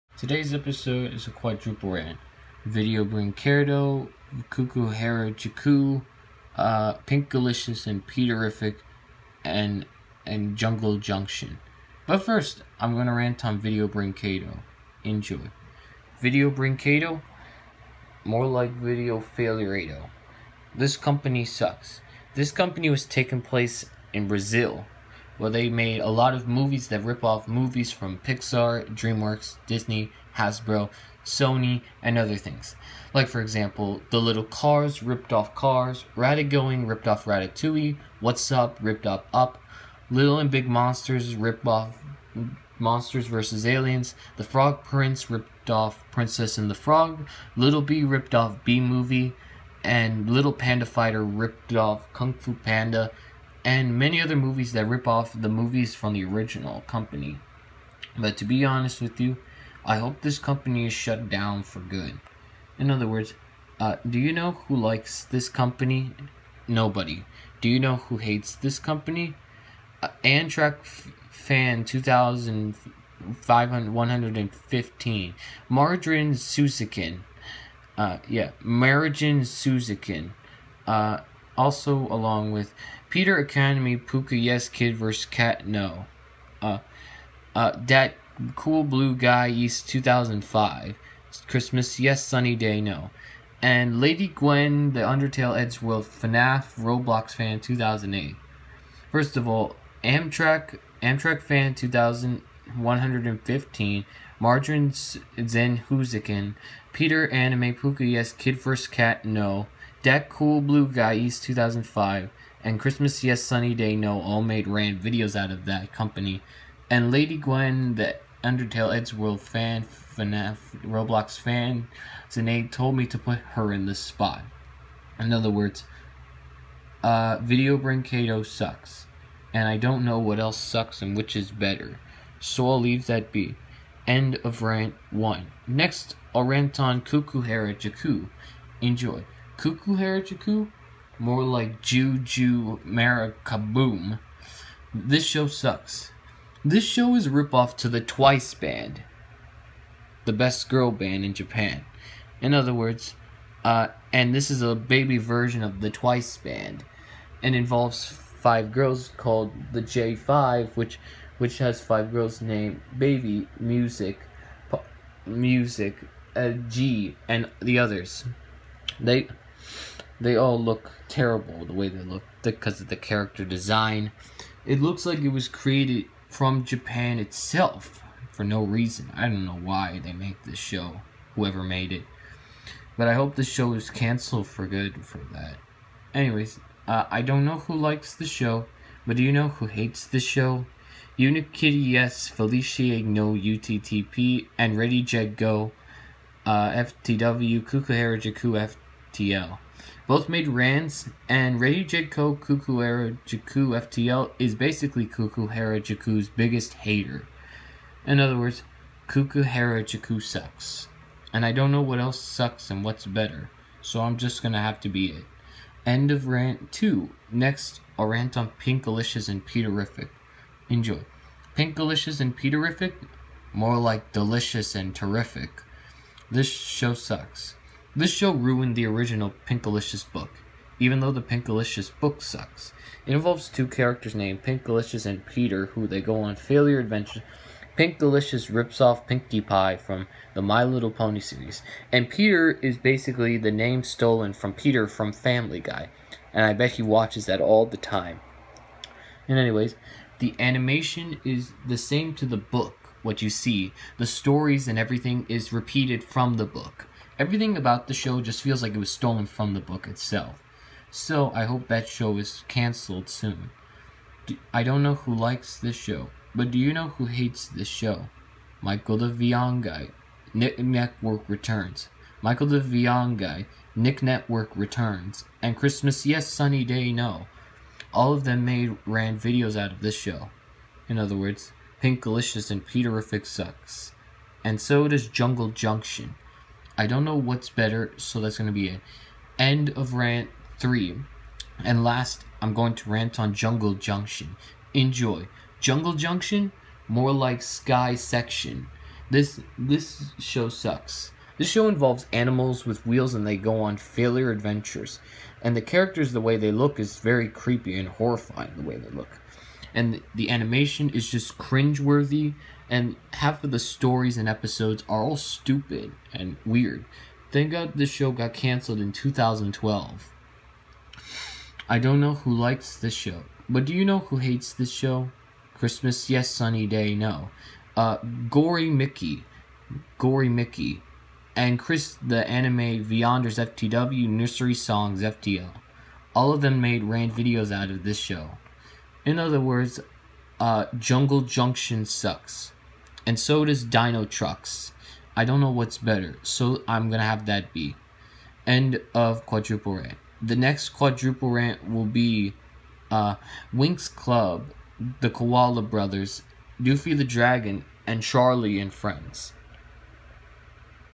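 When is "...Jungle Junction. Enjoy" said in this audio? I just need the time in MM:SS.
04:53.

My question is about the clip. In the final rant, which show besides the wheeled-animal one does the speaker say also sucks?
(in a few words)
Dino Trucks.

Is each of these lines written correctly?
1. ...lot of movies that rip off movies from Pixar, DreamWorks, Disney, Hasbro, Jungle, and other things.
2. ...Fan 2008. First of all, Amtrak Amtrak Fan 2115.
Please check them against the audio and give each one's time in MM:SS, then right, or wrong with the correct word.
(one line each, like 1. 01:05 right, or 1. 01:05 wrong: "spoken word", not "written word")
1. 00:26 wrong: "Sony", not "Jungle"
2. 01:37 right.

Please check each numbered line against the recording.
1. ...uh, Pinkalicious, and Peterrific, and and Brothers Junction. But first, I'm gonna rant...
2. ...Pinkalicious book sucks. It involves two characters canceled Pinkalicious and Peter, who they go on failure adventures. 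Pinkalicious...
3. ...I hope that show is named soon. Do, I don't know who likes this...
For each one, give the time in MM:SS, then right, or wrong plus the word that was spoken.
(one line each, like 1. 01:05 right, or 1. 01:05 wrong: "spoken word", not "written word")
1. 00:05 wrong: "Jungle", not "Brothers"
2. 03:51 wrong: "named", not "canceled"
3. 04:21 wrong: "canceled", not "named".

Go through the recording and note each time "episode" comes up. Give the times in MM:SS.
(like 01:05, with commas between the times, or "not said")
00:00, 05:14.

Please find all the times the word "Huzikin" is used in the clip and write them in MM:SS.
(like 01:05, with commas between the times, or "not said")
01:45.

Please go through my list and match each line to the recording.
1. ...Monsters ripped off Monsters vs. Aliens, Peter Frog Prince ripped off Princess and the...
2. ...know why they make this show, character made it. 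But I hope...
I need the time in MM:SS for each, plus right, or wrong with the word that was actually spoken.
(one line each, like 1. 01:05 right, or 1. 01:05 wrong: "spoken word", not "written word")
1. 00:40 wrong: "The", not "Peter"
2. 02:59 wrong: "whoever", not "character".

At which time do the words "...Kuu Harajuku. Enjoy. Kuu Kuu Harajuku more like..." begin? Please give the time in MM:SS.
02:17.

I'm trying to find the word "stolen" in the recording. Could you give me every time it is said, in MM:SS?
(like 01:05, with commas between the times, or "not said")
04:03, 04:18.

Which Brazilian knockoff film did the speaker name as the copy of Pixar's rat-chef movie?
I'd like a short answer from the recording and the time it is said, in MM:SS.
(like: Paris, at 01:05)
Ratagoing, at 00:36.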